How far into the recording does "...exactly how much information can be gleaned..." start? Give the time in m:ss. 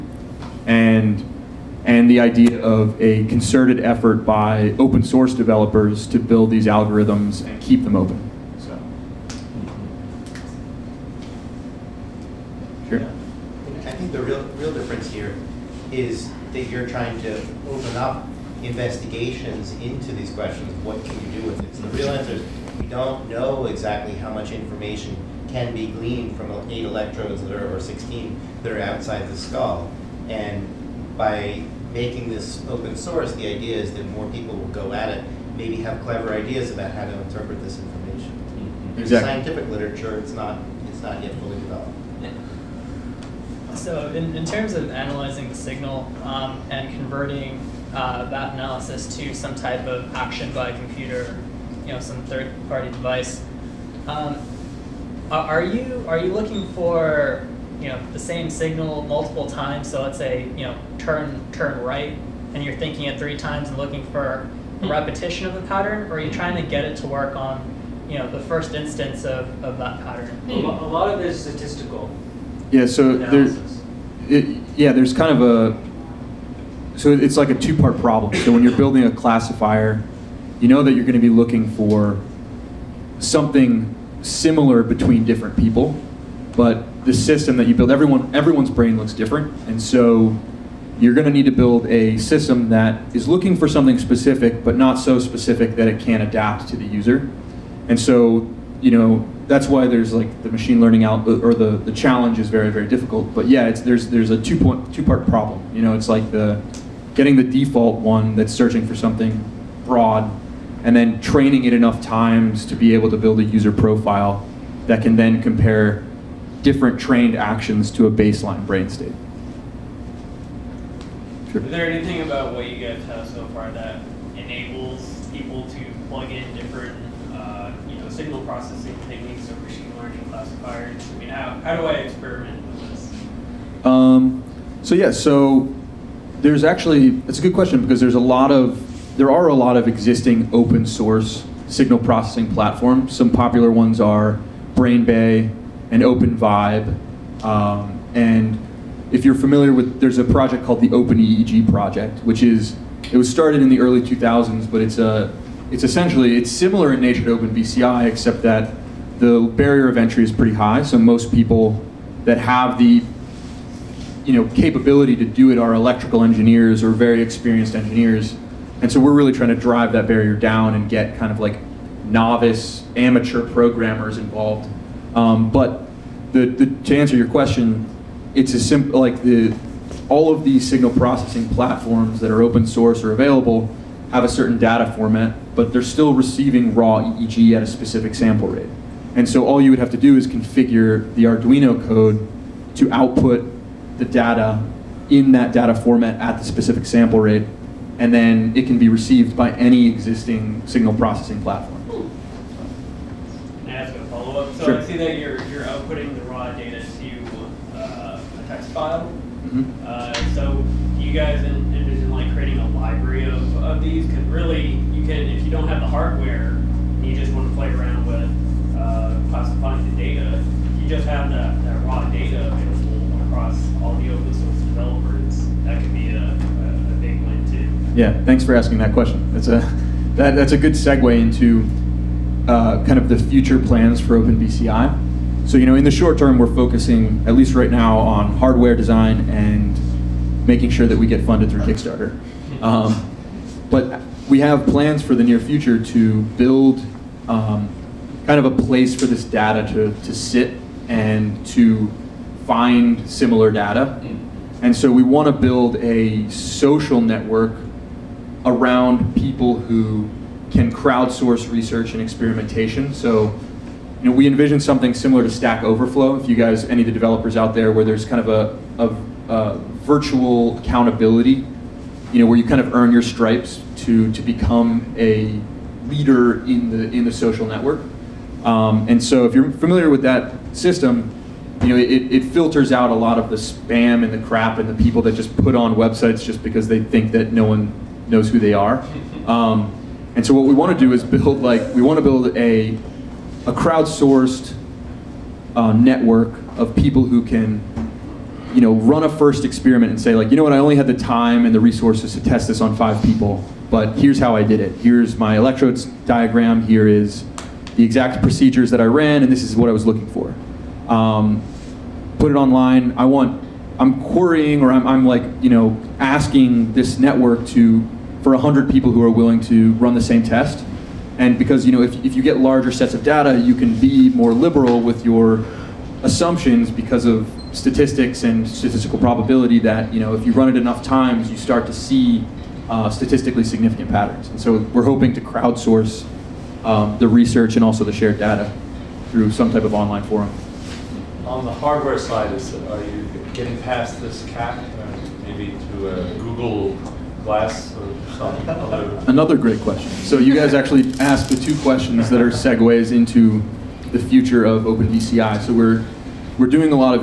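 0:23.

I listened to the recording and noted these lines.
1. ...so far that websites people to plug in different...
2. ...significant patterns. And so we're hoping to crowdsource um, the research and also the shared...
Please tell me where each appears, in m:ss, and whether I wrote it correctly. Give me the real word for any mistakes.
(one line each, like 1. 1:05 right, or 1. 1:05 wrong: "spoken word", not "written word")
1. 2:03 wrong: "enables", not "websites"
2. 5:33 right.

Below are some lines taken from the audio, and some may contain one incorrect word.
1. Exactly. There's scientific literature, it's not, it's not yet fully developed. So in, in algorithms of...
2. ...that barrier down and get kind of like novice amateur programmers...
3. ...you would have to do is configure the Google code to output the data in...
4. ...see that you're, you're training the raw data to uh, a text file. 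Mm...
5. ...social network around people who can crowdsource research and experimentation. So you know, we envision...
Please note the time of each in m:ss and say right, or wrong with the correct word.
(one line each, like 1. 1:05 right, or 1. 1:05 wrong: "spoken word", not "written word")
1. 0:39 wrong: "terms", not "algorithms"
2. 2:49 right
3. 3:09 wrong: "Arduino", not "Google"
4. 3:24 wrong: "outputting", not "training"
5. 4:16 right.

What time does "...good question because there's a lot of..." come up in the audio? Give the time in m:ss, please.
2:17.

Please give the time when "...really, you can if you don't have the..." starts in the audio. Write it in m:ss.
3:34.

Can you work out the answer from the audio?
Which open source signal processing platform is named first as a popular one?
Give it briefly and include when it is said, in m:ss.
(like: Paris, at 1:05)
BrainBay, at 2:24.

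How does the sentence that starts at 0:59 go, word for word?
So let's say you know turn turn right, and you're thinking it three times and looking for a hmm.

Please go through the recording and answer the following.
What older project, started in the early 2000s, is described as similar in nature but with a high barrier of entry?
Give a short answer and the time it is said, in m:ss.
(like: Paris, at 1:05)
OpenEEG project, at 2:30.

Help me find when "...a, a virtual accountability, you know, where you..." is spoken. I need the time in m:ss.
4:28.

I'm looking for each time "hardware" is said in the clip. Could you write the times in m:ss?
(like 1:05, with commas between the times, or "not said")
3:35, 3:58, 5:41.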